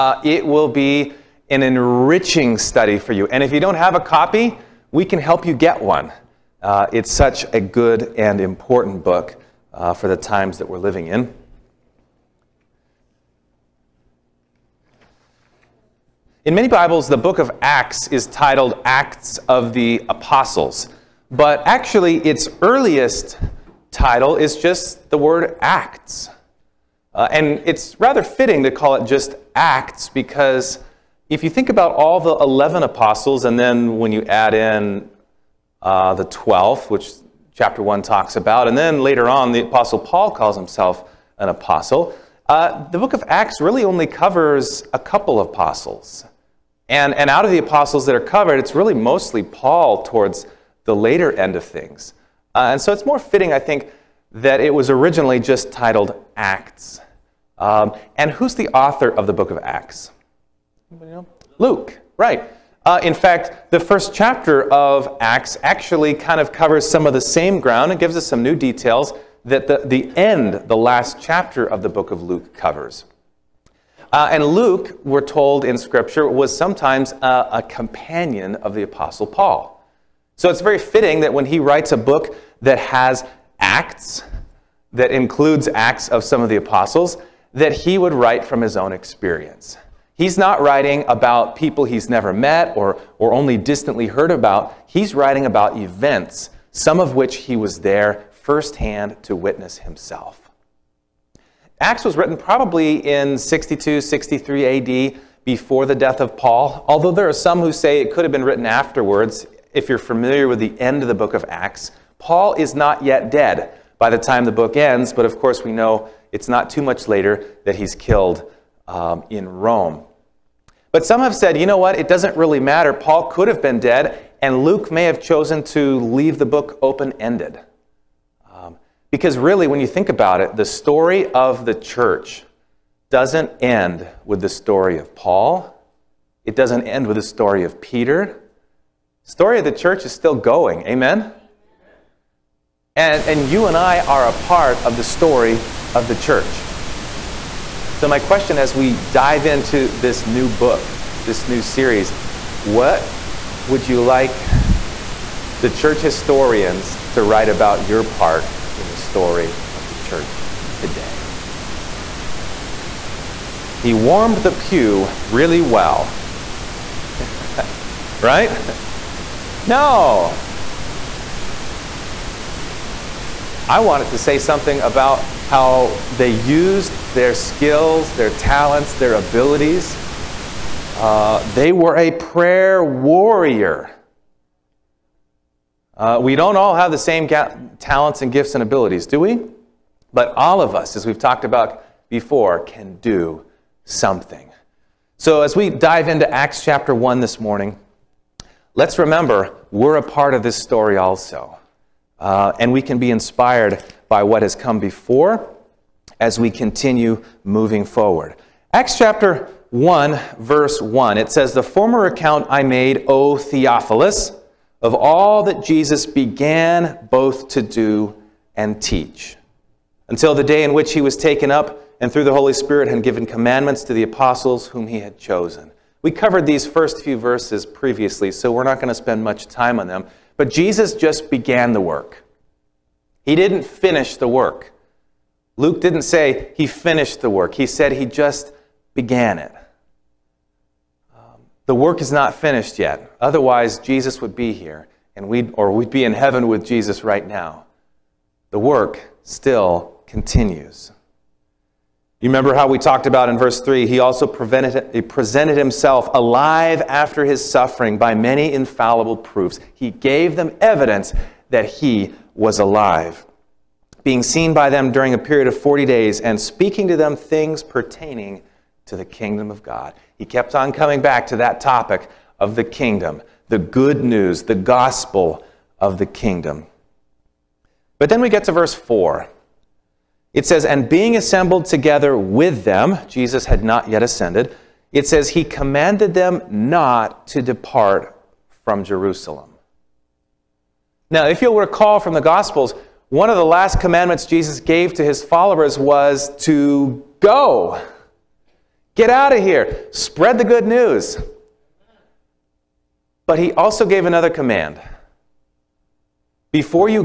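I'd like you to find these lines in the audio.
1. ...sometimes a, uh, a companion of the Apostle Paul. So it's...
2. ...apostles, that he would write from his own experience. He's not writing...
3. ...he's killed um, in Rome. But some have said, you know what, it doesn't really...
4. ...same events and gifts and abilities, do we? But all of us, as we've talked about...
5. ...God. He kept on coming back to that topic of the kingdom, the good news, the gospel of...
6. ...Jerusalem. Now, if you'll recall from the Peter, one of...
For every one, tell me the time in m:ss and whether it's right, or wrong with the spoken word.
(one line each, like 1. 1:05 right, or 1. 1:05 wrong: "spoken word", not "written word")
1. 1:16 right
2. 1:26 right
3. 1:57 right
4. 3:06 wrong: "talents", not "events"
5. 4:29 right
6. 4:48 wrong: "Gospels", not "Peter".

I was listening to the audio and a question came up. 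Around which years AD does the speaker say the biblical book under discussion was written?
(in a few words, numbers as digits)
62, 63 AD.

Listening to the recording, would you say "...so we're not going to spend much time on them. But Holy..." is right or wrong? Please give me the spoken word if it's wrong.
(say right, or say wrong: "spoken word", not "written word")
wrong: "Jesus", not "Holy".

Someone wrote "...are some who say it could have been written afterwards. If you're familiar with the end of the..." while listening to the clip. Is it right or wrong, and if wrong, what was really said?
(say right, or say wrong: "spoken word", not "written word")
right.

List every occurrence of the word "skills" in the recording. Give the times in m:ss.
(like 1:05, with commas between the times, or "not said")
2:57.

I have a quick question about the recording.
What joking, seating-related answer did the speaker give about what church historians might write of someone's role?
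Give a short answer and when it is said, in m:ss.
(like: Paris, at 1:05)
He warmed the pew, at 2:43.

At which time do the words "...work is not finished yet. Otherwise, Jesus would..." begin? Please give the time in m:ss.
4:01.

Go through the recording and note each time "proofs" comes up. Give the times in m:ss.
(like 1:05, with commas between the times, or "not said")
4:19.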